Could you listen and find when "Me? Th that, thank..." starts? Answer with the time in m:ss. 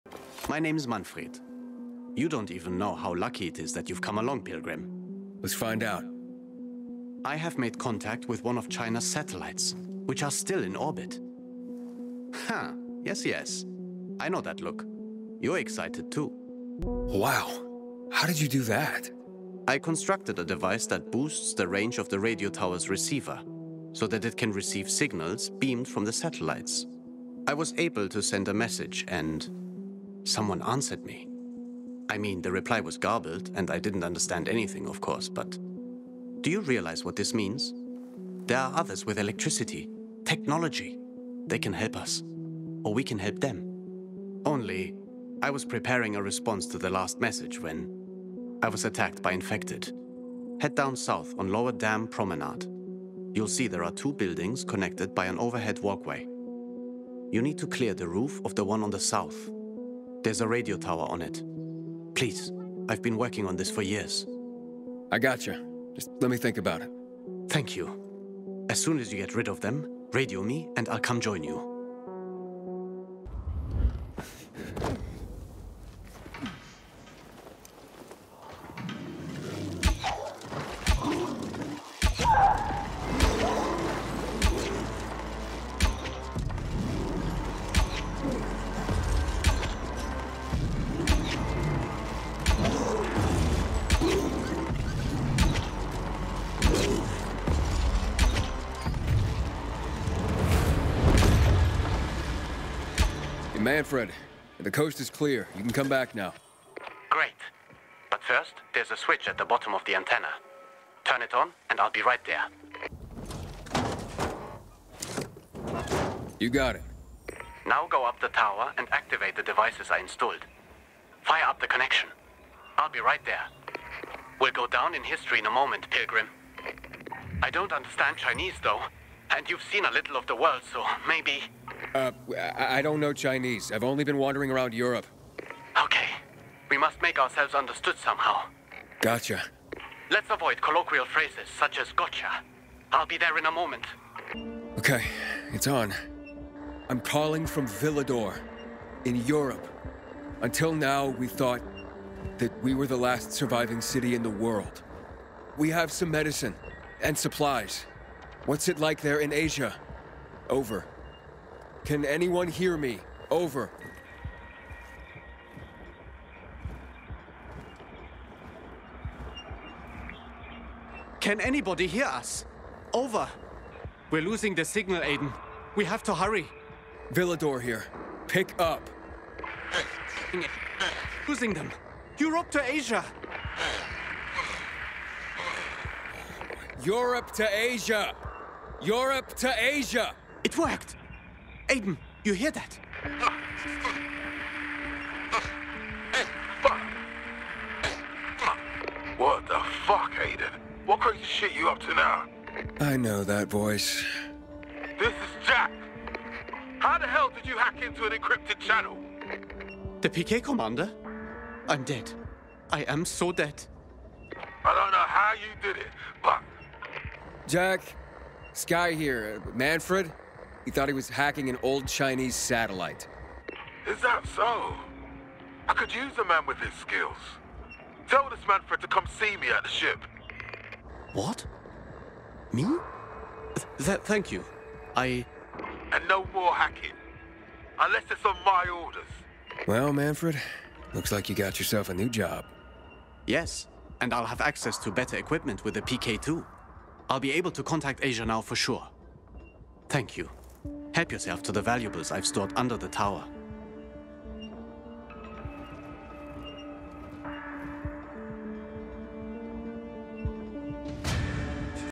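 3:52.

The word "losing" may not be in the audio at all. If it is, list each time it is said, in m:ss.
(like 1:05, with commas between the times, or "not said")
2:54, 3:01.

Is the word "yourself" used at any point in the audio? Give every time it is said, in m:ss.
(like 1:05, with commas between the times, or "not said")
4:01, 4:11.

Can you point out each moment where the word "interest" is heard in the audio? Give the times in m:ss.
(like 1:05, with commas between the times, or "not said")
not said.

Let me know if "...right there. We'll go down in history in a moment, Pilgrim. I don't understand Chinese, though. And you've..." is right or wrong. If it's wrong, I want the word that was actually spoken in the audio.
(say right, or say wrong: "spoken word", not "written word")
right.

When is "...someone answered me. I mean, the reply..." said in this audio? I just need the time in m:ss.
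0:30.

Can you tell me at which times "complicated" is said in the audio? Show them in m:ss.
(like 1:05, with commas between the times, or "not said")
not said.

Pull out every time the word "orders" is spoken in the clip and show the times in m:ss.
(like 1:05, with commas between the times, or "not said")
3:58.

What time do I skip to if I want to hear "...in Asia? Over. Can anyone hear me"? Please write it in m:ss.
2:39.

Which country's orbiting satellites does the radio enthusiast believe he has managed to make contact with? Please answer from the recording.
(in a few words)
China.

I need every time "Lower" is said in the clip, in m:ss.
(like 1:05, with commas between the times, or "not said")
0:51.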